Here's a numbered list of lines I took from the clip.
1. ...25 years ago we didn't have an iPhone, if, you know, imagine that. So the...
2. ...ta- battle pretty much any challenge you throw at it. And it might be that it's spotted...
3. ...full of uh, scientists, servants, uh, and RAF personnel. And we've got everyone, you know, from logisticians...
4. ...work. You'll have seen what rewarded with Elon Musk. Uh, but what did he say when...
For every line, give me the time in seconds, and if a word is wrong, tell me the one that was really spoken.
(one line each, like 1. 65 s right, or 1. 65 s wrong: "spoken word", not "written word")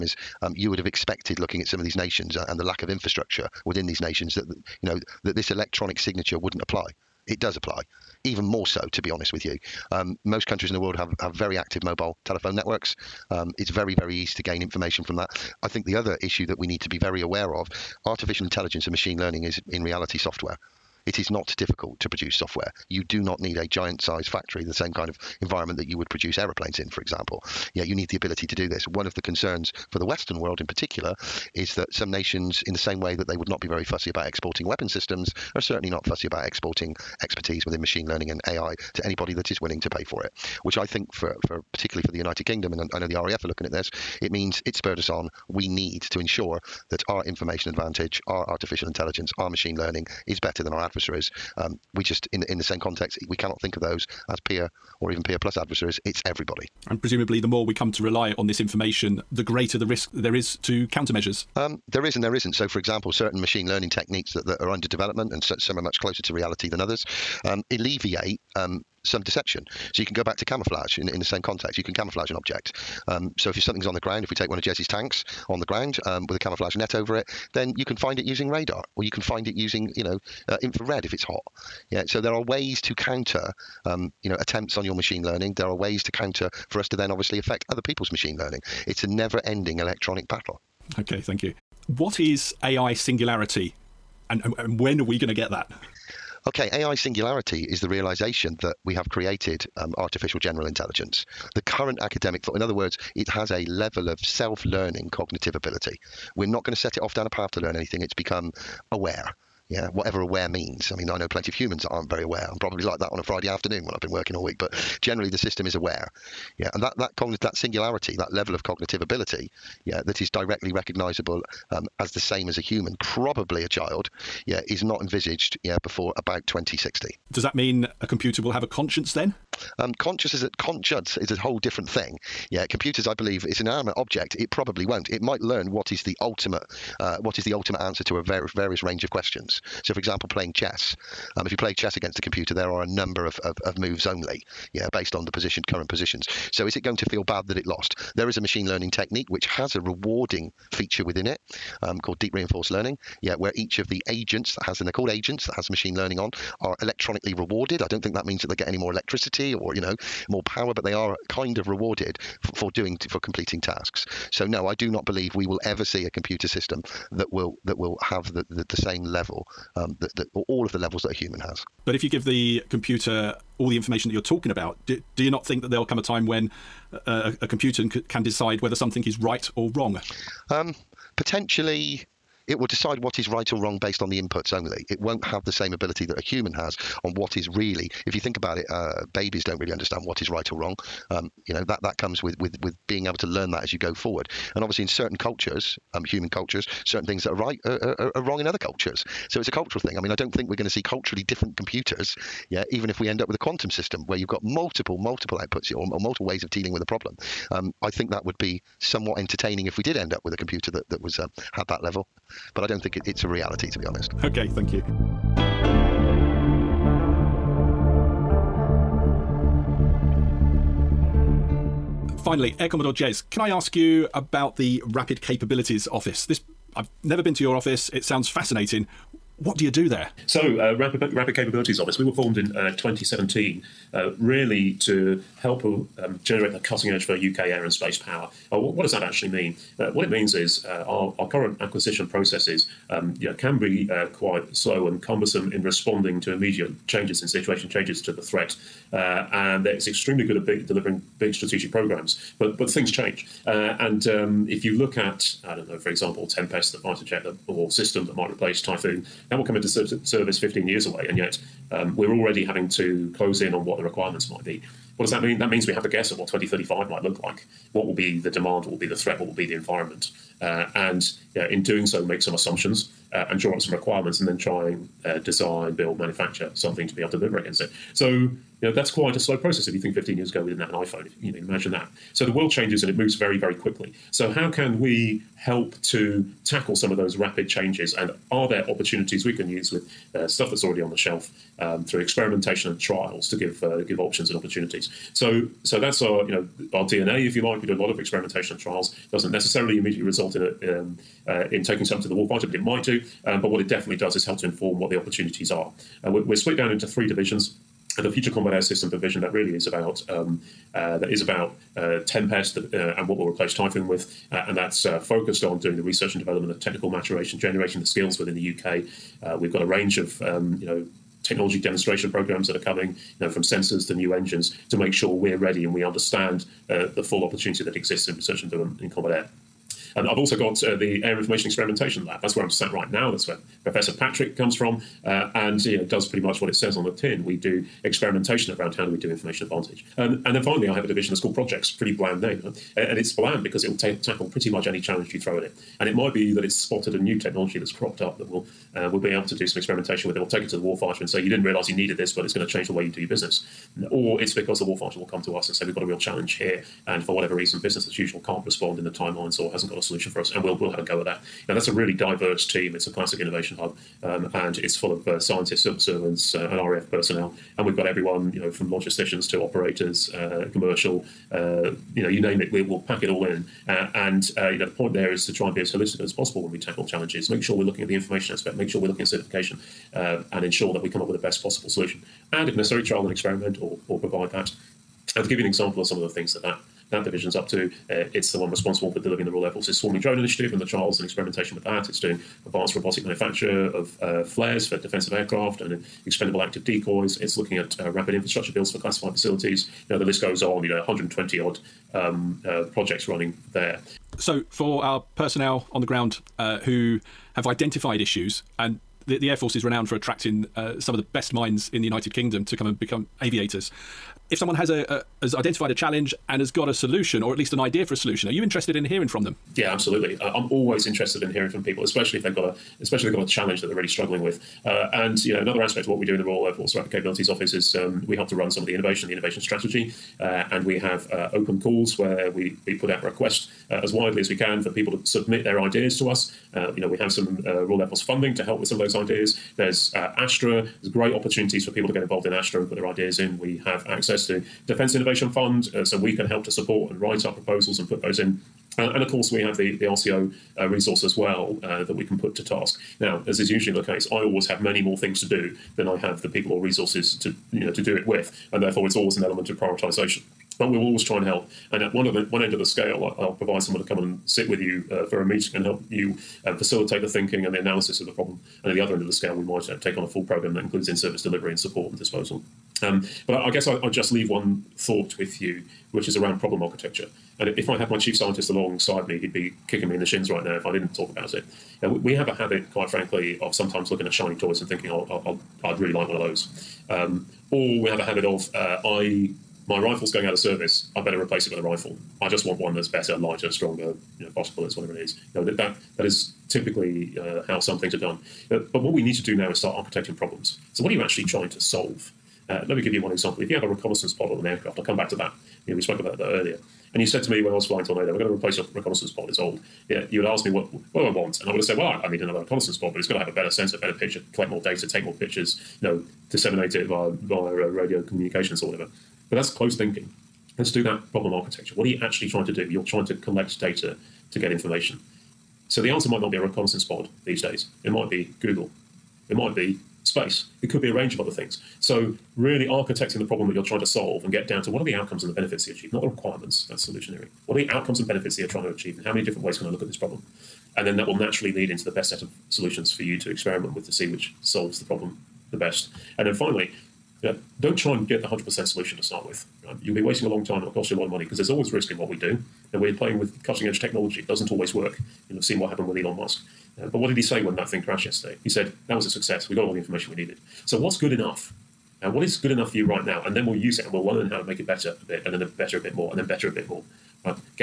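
1. 279 s wrong: "15", not "25"
2. 343 s wrong: "tackle", not "battle"
3. 364 s right
4. 554 s wrong: "happened", not "rewarded".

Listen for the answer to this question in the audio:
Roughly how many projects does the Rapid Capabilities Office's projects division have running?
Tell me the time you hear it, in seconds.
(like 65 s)
400 s.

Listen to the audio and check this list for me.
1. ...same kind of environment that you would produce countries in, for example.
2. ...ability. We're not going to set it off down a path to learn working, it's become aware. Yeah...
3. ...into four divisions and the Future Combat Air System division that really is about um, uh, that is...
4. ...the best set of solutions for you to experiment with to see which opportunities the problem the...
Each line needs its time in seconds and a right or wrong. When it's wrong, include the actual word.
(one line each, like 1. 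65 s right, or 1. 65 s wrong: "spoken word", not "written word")
1. 24 s wrong: "aeroplanes", not "countries"
2. 105 s wrong: "anything", not "working"
3. 306 s wrong: "three", not "four"
4. 541 s wrong: "solves", not "opportunities".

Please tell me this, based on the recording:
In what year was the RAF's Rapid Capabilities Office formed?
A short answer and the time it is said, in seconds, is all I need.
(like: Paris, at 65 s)
2017, at 232 s.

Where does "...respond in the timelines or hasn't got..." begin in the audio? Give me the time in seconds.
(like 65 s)
358 s.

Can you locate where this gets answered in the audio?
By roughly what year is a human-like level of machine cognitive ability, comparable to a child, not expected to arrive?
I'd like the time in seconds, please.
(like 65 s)
126 s.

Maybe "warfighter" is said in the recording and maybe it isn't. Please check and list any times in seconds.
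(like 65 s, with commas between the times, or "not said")
302 s, 350 s, 354 s.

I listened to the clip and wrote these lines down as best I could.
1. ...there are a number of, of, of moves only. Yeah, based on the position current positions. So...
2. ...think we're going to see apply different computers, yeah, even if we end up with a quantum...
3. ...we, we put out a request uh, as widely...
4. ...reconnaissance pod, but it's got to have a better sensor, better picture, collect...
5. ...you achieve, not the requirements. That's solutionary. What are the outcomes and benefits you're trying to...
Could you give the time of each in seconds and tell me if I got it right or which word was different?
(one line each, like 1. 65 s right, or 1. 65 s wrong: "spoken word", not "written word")
1. 142 s right
2. 200 s wrong: "culturally", not "apply"
3. 432 s right
4. 512 s right
5. 535 s right.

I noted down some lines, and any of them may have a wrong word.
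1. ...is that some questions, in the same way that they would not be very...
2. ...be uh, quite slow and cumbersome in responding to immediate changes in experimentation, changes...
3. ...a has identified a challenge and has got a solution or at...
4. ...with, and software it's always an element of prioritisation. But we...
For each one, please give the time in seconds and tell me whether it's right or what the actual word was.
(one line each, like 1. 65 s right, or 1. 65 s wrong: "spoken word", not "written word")
1. 31 s wrong: "nations", not "questions"
2. 243 s wrong: "situation", not "experimentation"
3. 414 s right
4. 458 s wrong: "therefore", not "software".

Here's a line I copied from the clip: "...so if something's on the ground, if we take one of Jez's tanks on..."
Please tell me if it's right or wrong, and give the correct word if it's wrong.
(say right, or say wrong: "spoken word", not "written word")
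right.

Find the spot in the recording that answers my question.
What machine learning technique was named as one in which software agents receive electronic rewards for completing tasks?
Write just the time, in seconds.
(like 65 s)
152 s.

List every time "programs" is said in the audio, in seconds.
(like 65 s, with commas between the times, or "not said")
251 s, 322 s, 470 s.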